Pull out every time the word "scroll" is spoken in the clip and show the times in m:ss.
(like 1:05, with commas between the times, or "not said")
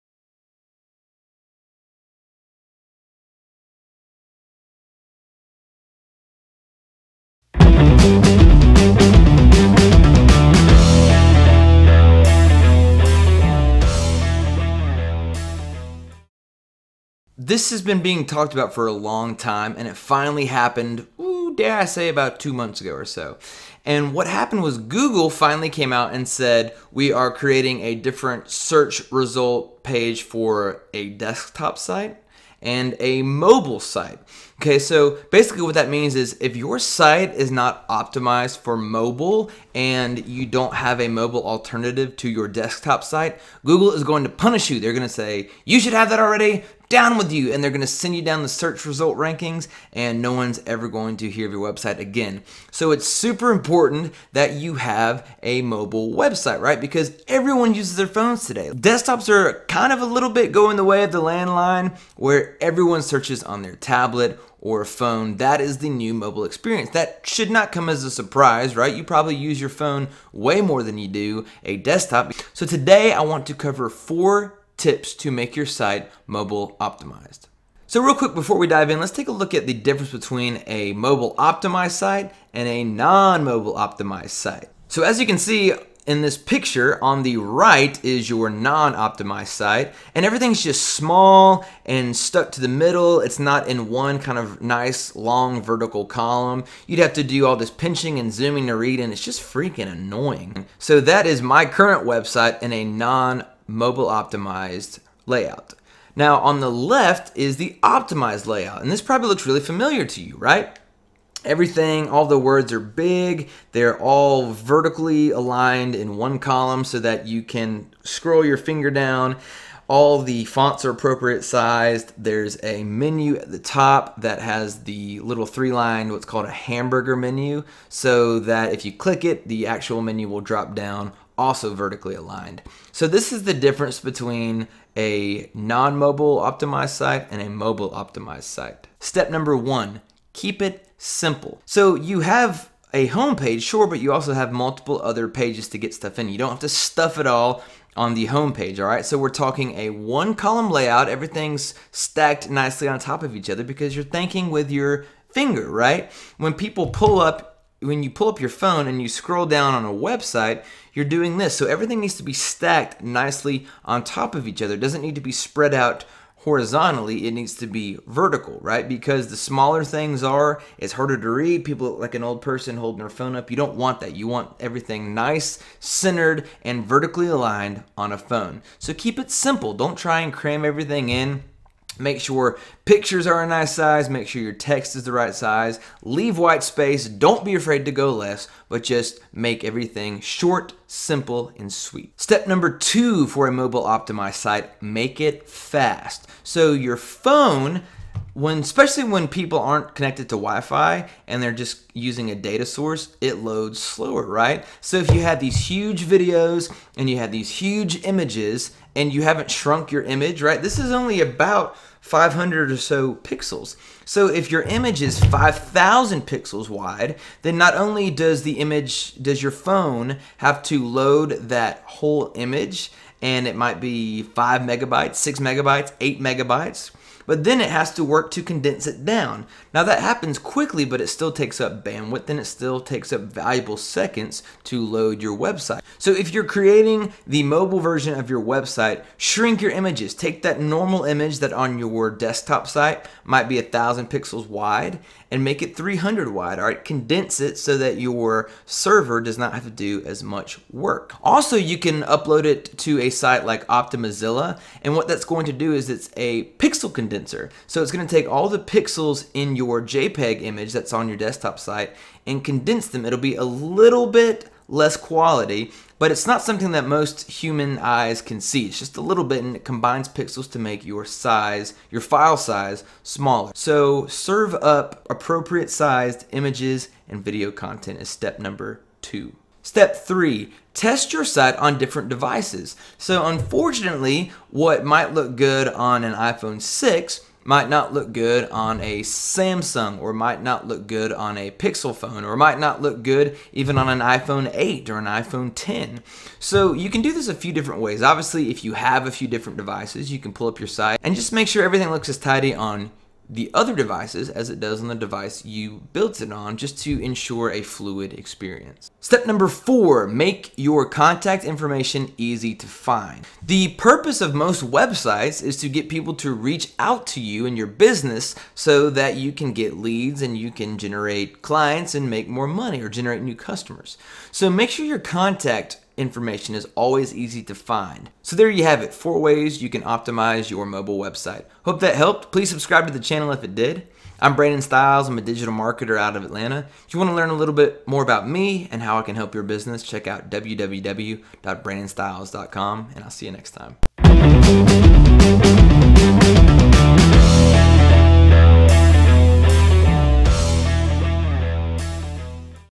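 1:58, 2:39.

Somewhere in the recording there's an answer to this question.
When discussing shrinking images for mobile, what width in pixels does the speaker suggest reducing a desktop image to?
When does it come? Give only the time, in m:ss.
4:05.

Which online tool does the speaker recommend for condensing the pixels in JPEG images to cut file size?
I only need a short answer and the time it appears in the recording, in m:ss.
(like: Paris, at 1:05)
Optimizilla, at 4:13.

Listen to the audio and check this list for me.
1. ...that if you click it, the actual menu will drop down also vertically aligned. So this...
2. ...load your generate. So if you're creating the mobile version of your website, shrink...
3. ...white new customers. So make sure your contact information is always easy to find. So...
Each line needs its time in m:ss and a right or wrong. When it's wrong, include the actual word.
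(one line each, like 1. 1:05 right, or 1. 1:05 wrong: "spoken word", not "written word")
1. 2:08 right
2. 3:54 wrong: "website", not "generate"
3. 5:22 wrong: "generate", not "white".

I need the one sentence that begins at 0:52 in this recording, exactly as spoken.
So it's super important that you have a mobile website, right?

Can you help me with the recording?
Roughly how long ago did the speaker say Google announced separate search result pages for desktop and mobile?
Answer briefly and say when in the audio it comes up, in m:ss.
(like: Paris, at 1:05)
about two months, at 0:22.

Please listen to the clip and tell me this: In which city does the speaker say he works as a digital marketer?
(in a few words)
Atlanta.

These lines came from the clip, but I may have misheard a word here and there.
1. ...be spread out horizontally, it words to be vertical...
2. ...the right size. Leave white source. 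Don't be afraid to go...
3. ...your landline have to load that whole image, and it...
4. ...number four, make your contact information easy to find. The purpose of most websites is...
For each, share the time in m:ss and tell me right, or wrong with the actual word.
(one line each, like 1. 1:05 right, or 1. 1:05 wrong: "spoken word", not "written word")
1. 2:45 wrong: "needs", not "words"
2. 3:05 wrong: "space", not "source"
3. 3:39 wrong: "phone", not "landline"
4. 5:09 right.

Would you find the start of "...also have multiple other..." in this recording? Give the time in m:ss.
2:24.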